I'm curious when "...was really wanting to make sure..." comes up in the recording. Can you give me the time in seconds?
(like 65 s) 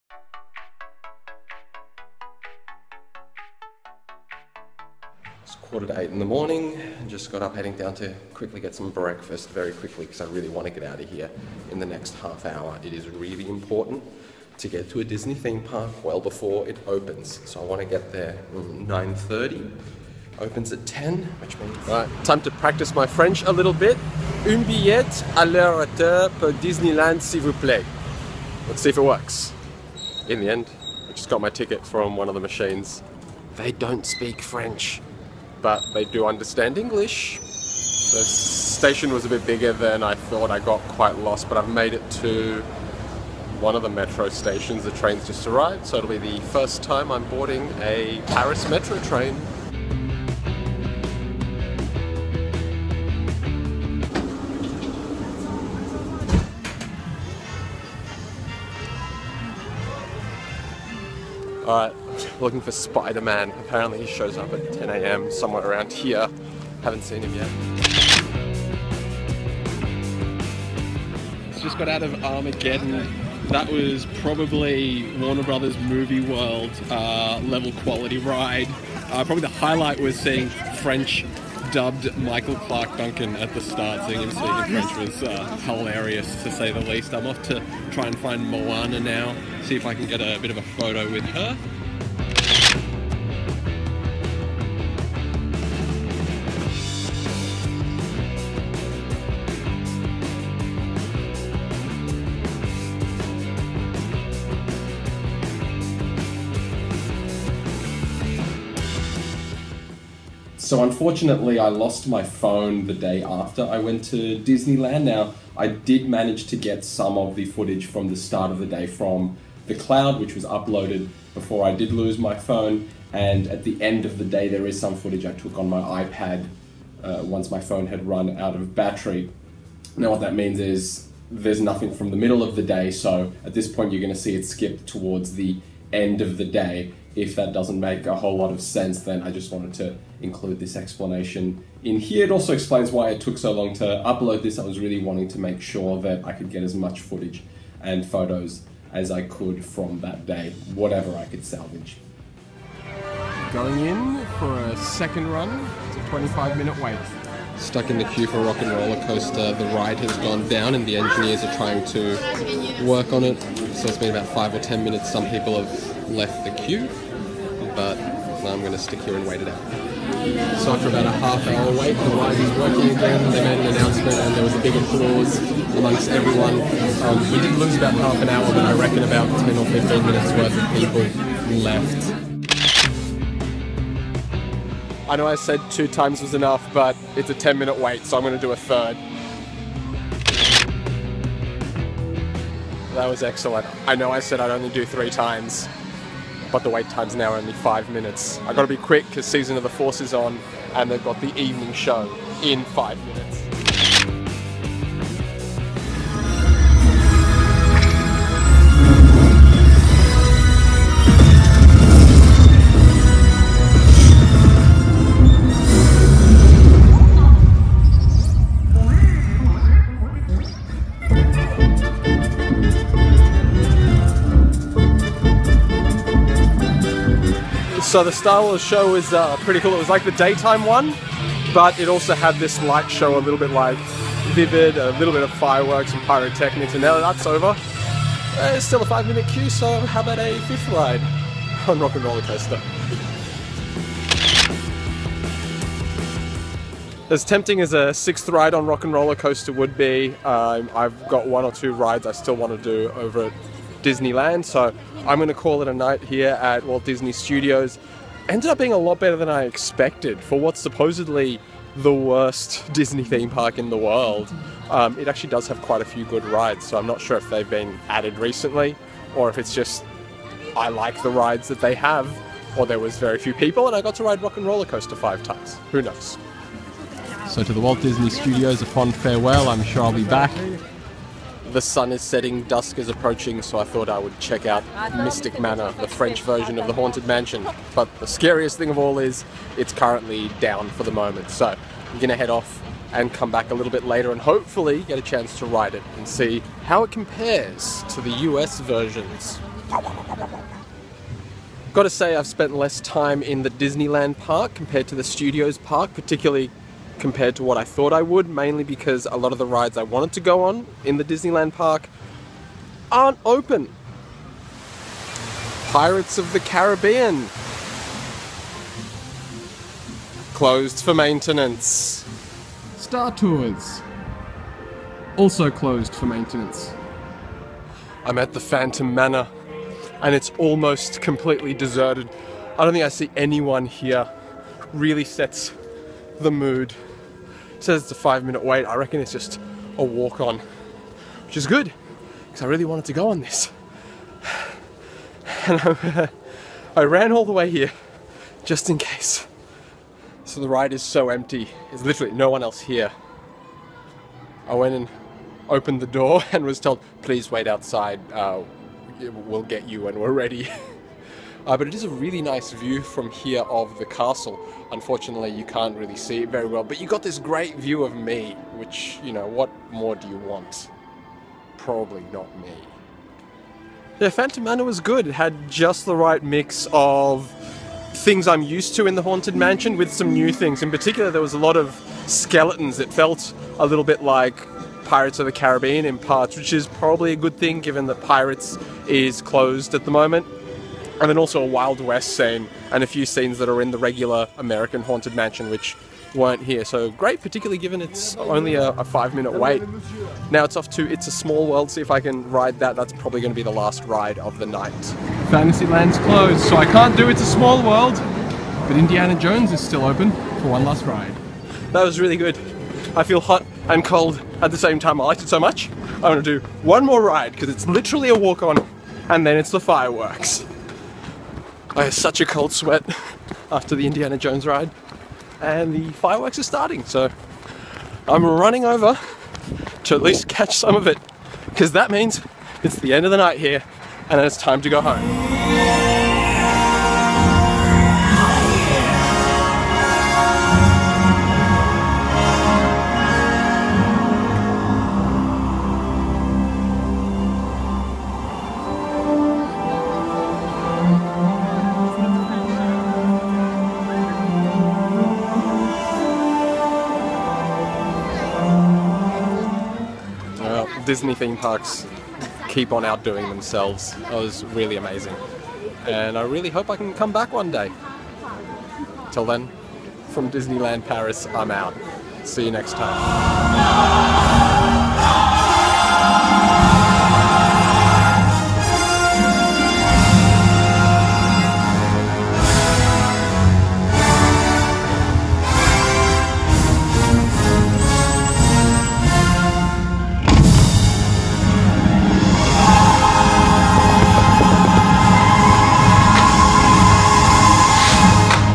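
144 s.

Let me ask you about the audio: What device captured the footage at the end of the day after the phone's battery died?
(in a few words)
iPad.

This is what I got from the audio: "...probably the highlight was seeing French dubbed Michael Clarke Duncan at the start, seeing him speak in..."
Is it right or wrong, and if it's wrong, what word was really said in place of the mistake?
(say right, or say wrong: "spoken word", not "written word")
right.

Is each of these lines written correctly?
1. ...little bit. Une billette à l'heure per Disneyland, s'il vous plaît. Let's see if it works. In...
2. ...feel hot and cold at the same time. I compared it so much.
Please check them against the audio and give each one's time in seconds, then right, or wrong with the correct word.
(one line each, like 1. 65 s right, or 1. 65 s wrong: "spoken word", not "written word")
1. 23 s right
2. 413 s wrong: "liked", not "compared".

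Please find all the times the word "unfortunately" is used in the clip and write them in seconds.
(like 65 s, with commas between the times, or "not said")
110 s, 364 s.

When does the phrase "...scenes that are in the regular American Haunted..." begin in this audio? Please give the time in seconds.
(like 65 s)
393 s.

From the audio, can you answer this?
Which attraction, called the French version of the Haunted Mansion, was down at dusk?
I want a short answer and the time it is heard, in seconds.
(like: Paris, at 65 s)
Mystic Manor, at 284 s.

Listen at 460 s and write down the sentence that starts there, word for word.
Disney theme parks keep on outdoing themselves.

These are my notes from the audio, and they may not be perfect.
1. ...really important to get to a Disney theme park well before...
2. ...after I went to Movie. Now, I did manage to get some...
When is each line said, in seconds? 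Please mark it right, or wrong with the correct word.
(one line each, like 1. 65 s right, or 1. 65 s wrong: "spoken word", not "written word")
1. 13 s right
2. 113 s wrong: "Disneyland", not "Movie".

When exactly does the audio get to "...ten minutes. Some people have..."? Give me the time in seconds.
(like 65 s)
164 s.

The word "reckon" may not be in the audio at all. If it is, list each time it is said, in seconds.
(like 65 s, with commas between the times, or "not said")
178 s, 338 s.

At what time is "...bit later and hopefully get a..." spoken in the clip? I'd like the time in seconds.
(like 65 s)
293 s.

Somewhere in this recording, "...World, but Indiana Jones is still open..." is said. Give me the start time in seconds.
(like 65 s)
407 s.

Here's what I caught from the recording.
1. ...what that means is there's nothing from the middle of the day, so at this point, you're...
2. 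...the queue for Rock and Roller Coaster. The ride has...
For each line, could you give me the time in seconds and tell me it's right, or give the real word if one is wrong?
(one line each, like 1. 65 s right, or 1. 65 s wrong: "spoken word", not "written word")
1. 130 s right
2. 157 s right.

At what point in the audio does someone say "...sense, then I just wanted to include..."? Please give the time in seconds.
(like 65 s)
138 s.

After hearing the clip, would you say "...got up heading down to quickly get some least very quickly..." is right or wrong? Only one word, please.
wrong.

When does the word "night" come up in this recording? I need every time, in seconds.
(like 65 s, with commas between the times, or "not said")
255 s, 404 s, 433 s.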